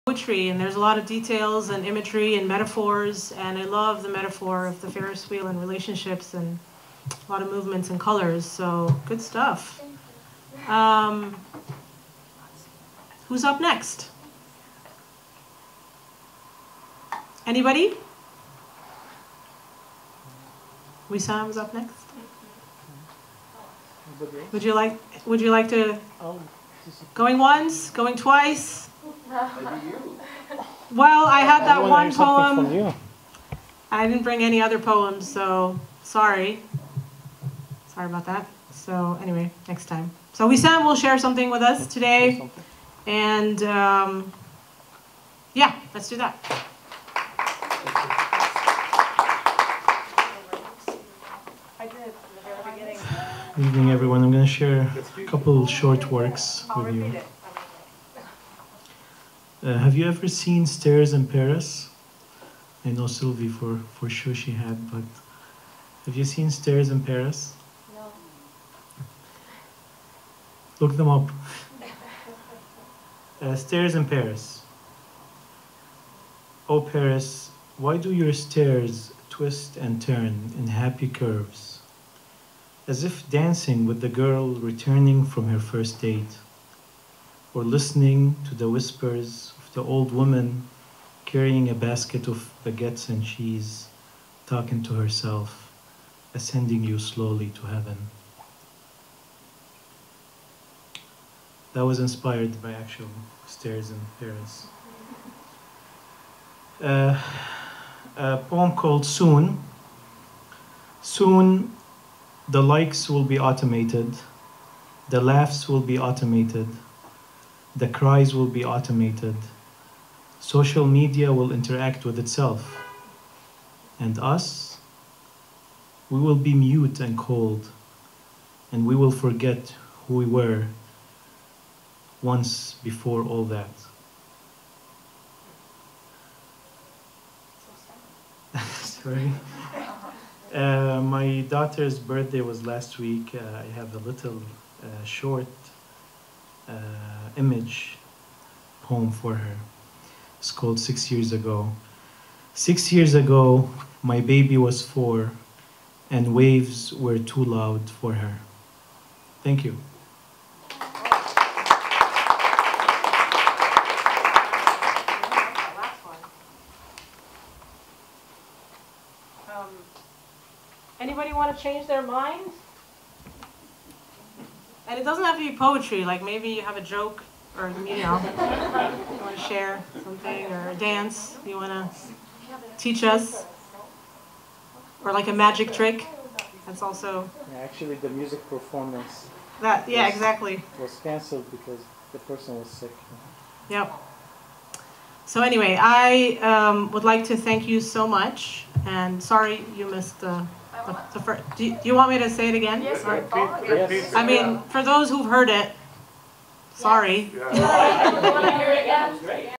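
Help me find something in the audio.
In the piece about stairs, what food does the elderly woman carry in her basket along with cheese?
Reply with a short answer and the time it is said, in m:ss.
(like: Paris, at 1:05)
Baguettes, at 1:32.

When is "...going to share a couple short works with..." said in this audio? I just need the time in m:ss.
0:54.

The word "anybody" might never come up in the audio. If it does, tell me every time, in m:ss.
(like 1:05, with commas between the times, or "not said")
0:17, 2:50.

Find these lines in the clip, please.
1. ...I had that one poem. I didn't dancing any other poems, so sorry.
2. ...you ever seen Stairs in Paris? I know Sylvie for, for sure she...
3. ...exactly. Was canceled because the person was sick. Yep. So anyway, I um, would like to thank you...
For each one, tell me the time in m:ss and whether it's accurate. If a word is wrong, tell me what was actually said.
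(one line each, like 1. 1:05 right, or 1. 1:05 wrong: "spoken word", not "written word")
1. 0:31 wrong: "bring", not "dancing"
2. 0:59 right
3. 3:10 right.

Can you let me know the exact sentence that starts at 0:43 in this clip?
And um, yeah, let's do that.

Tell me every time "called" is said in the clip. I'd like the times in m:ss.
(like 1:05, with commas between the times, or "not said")
1:48, 2:30.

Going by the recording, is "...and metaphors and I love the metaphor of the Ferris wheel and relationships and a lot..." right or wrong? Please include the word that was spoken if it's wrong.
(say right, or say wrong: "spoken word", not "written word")
right.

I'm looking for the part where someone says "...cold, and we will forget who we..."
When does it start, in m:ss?
2:07.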